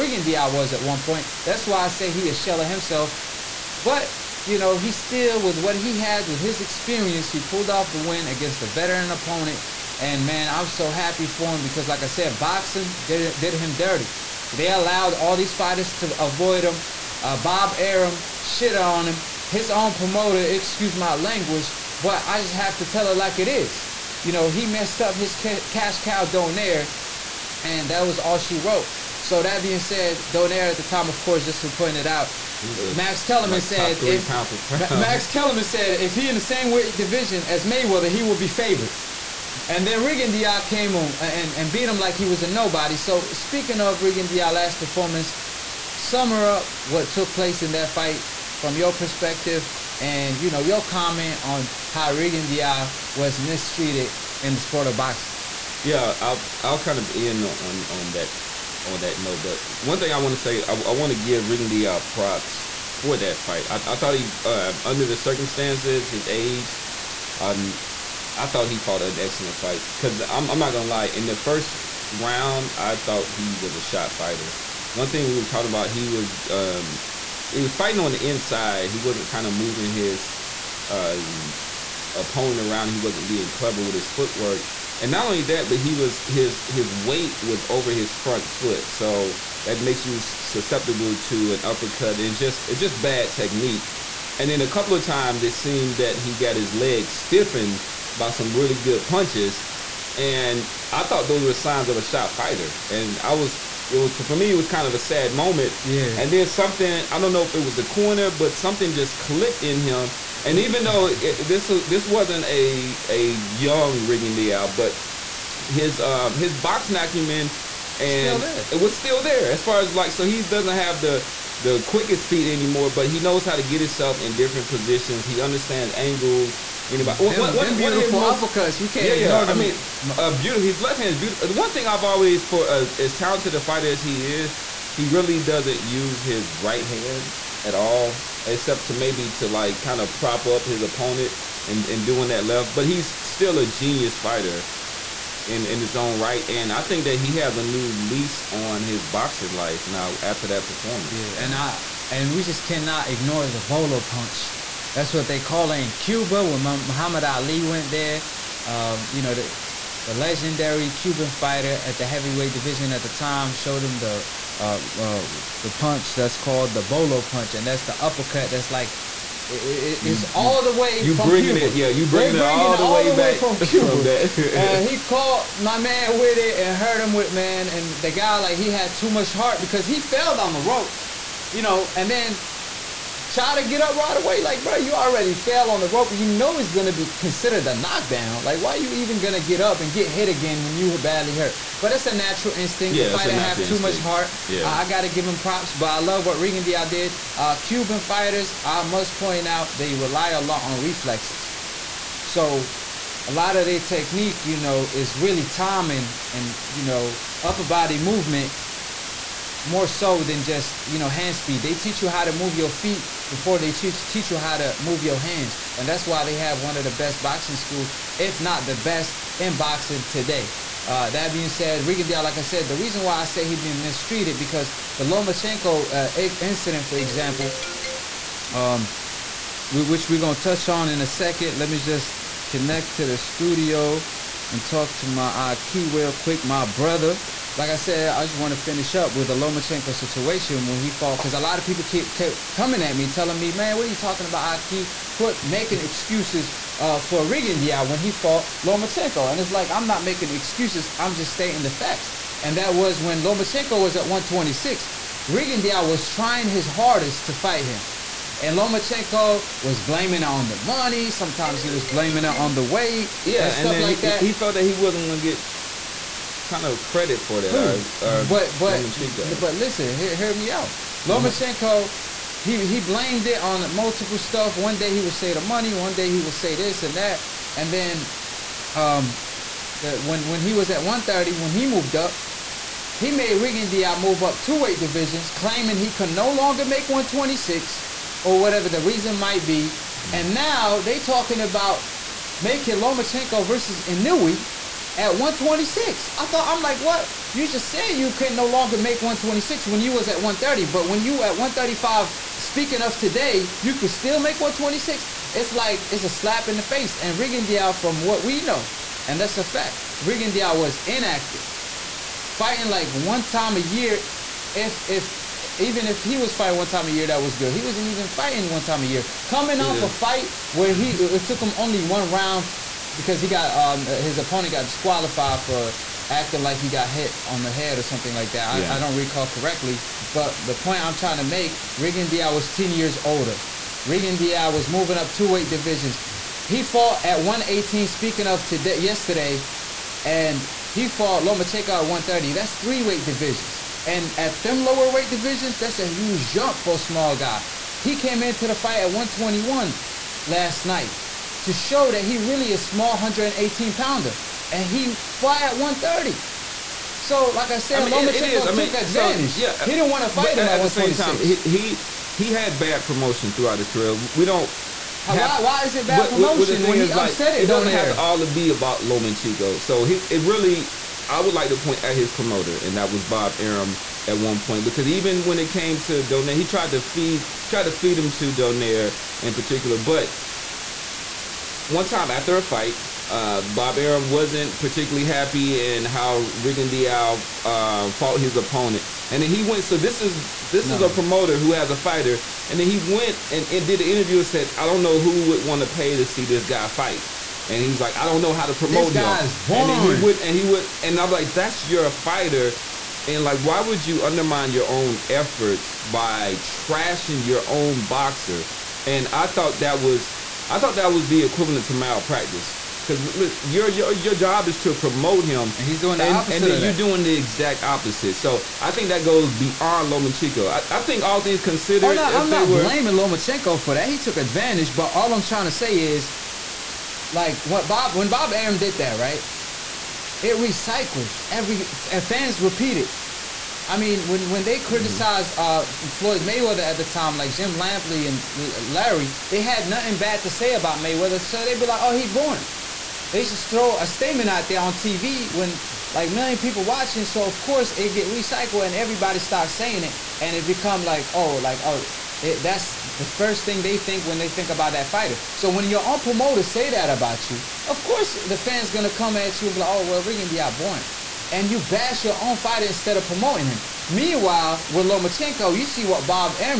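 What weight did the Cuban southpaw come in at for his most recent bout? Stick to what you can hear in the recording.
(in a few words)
121.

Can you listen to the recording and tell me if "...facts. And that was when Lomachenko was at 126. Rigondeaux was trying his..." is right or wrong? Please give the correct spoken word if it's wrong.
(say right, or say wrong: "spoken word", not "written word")
right.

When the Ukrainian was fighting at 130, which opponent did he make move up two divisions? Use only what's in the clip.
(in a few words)
Diaz.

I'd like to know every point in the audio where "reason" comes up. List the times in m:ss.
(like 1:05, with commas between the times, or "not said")
3:42, 4:48.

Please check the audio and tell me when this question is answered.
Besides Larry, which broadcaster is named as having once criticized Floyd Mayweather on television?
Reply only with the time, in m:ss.
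7:17.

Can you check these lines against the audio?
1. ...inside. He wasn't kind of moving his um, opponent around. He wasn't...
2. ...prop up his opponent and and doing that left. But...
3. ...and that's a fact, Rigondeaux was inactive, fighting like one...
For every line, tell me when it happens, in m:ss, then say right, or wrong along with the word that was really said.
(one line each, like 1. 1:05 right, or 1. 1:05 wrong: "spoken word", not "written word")
1. 1:18 right
2. 2:20 right
3. 5:09 right.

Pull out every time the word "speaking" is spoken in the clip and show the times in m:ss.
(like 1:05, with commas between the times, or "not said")
0:43, 5:02, 5:37.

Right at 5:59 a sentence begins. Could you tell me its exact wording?
So, yeah, he didn't want to fight him at, at the same time.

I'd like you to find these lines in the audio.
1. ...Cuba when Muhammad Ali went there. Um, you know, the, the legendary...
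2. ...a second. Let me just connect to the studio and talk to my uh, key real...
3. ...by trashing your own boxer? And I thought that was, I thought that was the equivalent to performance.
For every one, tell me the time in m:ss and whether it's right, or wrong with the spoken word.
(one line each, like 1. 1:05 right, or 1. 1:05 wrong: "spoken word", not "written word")
1. 2:35 right
2. 3:51 right
3. 6:45 wrong: "malpractice", not "performance".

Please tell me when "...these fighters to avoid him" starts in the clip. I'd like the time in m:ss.
0:15.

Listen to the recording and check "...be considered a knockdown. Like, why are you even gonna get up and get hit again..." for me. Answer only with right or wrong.
right.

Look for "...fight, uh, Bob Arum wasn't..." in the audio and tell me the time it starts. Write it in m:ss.
6:22.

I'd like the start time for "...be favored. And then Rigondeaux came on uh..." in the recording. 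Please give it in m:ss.
0:38.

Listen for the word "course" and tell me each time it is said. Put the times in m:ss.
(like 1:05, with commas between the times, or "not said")
0:31, 7:27, 7:37.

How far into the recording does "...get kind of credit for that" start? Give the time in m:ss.
4:25.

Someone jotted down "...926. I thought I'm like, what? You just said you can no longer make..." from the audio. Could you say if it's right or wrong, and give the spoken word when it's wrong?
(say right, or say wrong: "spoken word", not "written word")
wrong: "126", not "926".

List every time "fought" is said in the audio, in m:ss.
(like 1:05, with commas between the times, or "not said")
1:08, 4:00, 4:08, 5:36, 5:40, 6:27.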